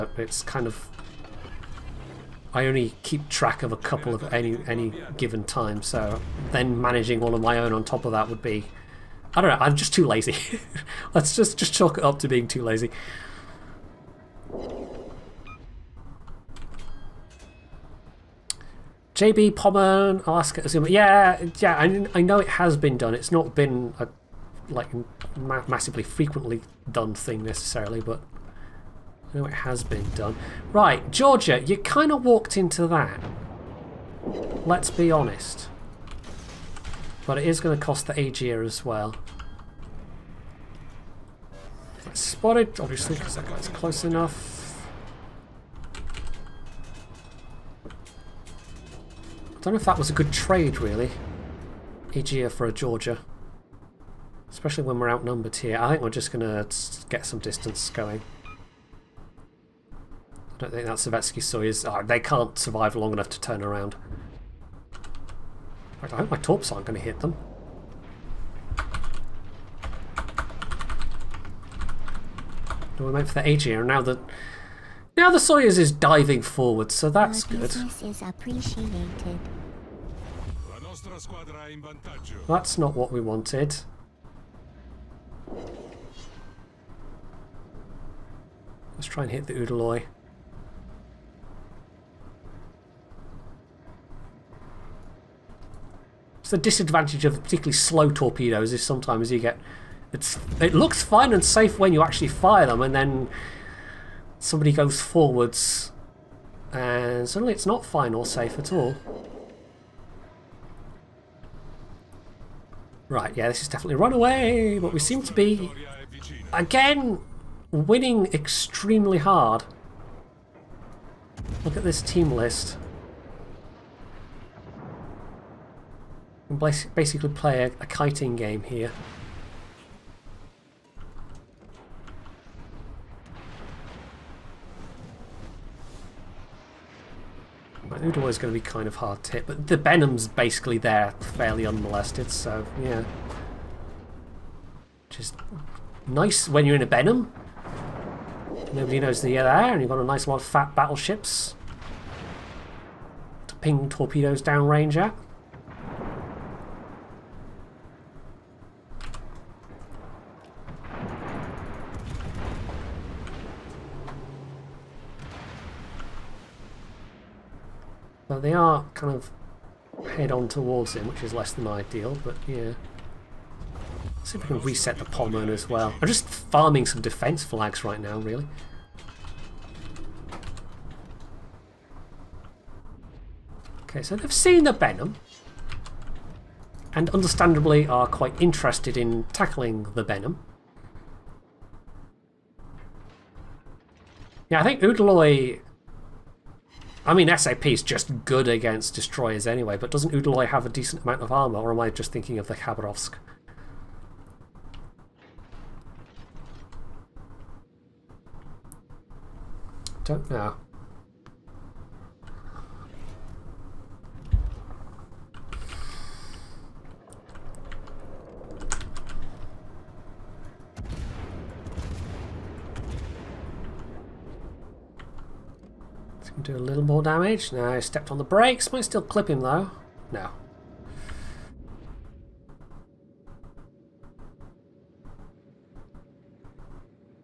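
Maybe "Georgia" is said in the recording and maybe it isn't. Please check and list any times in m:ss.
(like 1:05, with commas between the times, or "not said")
0:31, 0:52.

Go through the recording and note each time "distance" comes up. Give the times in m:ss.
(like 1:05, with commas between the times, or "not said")
0:57.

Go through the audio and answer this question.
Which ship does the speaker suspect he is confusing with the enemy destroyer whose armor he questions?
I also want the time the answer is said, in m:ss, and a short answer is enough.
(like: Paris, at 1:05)
Khabarovsk, at 3:22.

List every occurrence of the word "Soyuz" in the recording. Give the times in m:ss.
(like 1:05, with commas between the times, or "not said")
1:01, 1:15.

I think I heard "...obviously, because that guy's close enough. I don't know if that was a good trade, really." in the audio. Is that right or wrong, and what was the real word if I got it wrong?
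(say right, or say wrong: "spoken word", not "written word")
right.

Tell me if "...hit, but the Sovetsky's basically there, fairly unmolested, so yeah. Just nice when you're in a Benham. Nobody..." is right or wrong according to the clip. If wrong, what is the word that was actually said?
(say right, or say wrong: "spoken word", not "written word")
wrong: "Benham", not "Sovetsky".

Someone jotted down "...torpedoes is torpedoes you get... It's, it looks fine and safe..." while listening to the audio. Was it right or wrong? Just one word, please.
wrong.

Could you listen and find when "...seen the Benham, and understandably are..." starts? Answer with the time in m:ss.
3:04.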